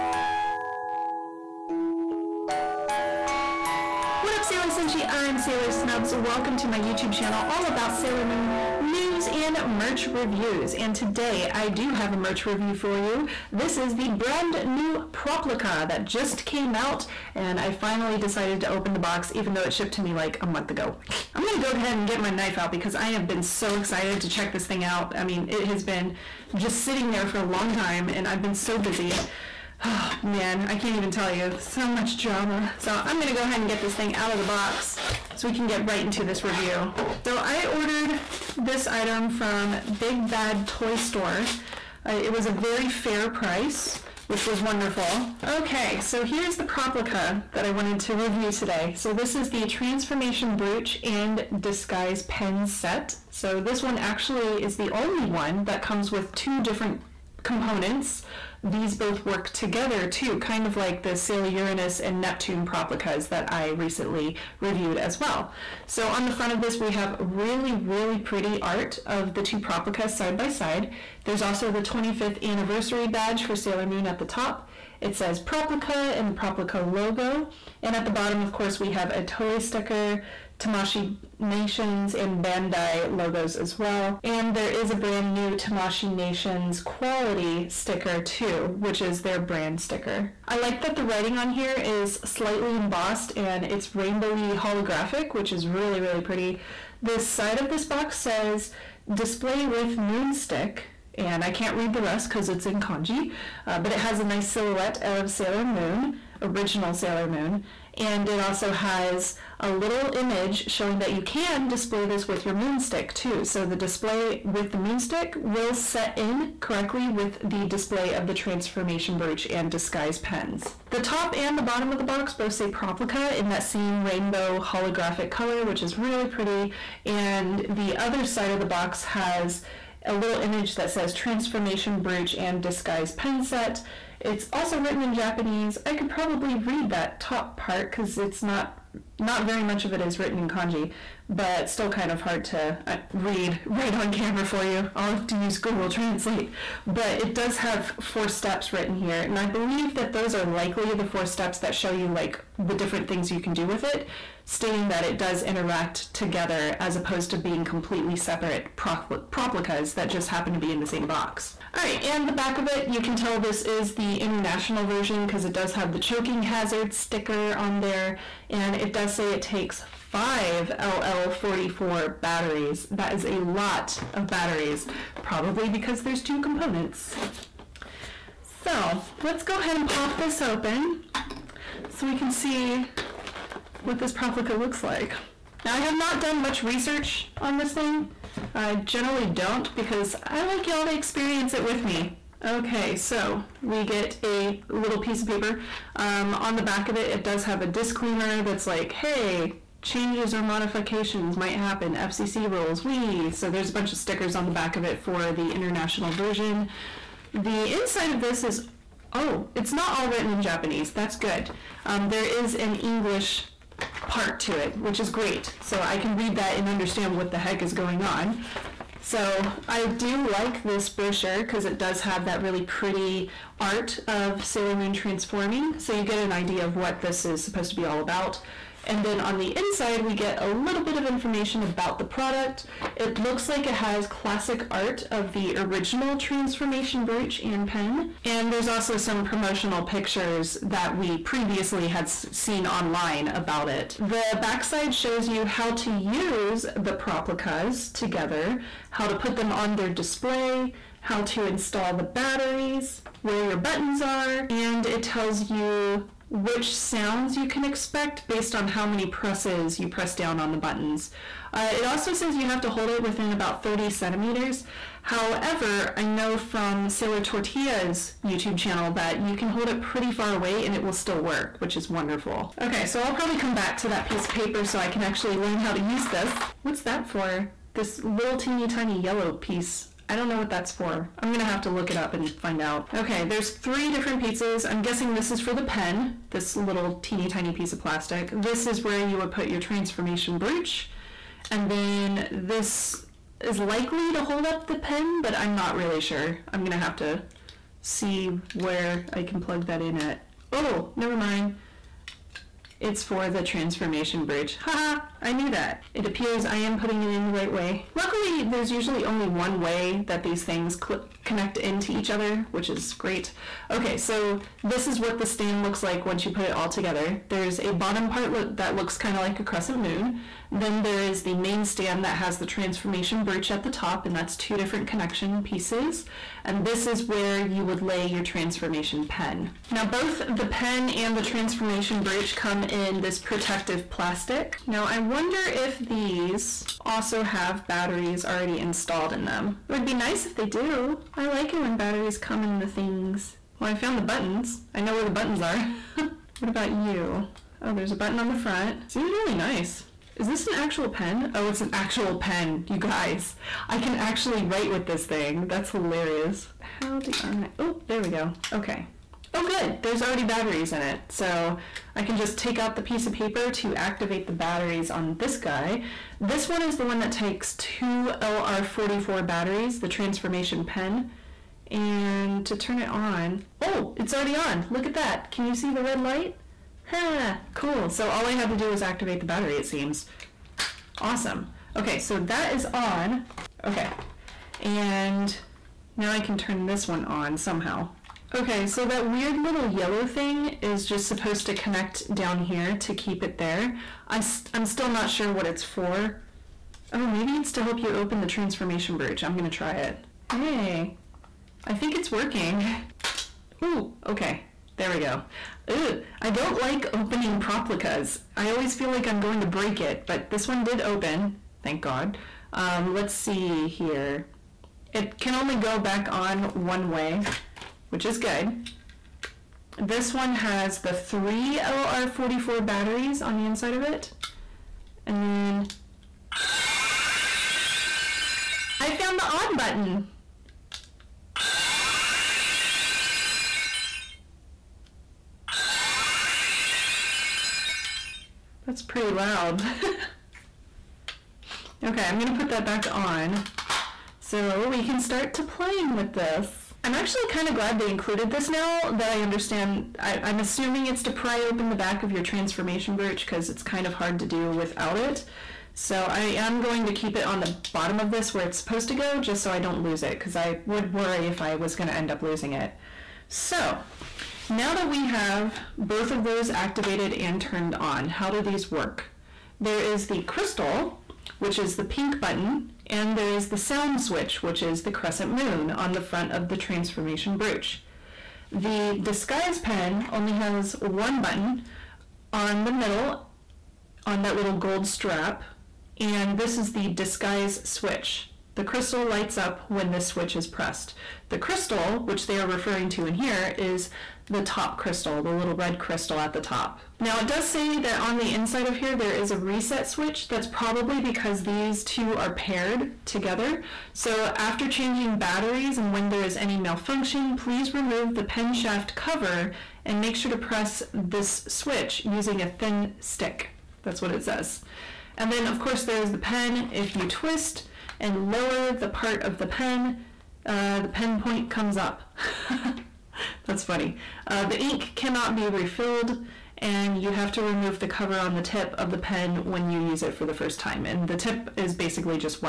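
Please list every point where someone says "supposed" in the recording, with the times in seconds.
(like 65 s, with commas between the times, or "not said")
227 s, 391 s, 458 s.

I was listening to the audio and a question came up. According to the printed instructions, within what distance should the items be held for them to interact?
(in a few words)
30 centimeters.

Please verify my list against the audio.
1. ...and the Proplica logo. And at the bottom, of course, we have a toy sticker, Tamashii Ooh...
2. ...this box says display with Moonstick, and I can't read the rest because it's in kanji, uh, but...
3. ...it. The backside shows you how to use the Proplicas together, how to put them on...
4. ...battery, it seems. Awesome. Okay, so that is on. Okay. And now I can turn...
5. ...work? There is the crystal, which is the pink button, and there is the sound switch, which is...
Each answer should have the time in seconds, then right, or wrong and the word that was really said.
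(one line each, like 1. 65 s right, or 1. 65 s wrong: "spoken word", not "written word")
1. 76 s wrong: "Nations", not "Ooh"
2. 97 s right
3. 243 s right
4. 379 s right
5. 468 s right.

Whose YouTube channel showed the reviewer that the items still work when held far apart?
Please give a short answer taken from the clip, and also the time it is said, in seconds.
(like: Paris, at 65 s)
Sailor Tortilla, at 266 s.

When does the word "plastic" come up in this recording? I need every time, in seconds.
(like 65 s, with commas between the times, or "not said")
287 s, 333 s.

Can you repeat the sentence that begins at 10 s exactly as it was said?
And today I do have a merch review for you.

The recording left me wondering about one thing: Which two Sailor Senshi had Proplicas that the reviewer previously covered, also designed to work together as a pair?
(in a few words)
Uranus and Neptune.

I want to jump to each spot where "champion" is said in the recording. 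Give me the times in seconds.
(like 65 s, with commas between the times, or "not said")
not said.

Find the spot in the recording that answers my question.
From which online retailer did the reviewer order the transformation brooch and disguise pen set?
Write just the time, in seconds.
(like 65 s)
39 s.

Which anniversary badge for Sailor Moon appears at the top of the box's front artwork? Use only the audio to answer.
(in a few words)
25th anniversary.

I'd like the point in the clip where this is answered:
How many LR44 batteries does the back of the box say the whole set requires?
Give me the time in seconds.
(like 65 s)
170 s.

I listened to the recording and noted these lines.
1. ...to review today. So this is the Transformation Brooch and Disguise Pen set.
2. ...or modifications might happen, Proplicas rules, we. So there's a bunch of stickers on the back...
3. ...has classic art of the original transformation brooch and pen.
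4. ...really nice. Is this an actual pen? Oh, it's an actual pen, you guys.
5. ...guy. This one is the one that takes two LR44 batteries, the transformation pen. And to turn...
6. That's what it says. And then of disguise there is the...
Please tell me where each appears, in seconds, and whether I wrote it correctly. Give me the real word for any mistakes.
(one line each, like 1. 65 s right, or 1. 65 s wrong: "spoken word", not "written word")
1. 48 s right
2. 200 s wrong: "FCC", not "Proplicas"
3. 233 s right
4. 349 s right
5. 365 s right
6. 513 s wrong: "course", not "disguise".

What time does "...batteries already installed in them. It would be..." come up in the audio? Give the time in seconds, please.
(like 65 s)
337 s.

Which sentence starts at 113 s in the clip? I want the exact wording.
So the display with the moonstick will set in correctly with the display of the transformation brooch and disguise pens.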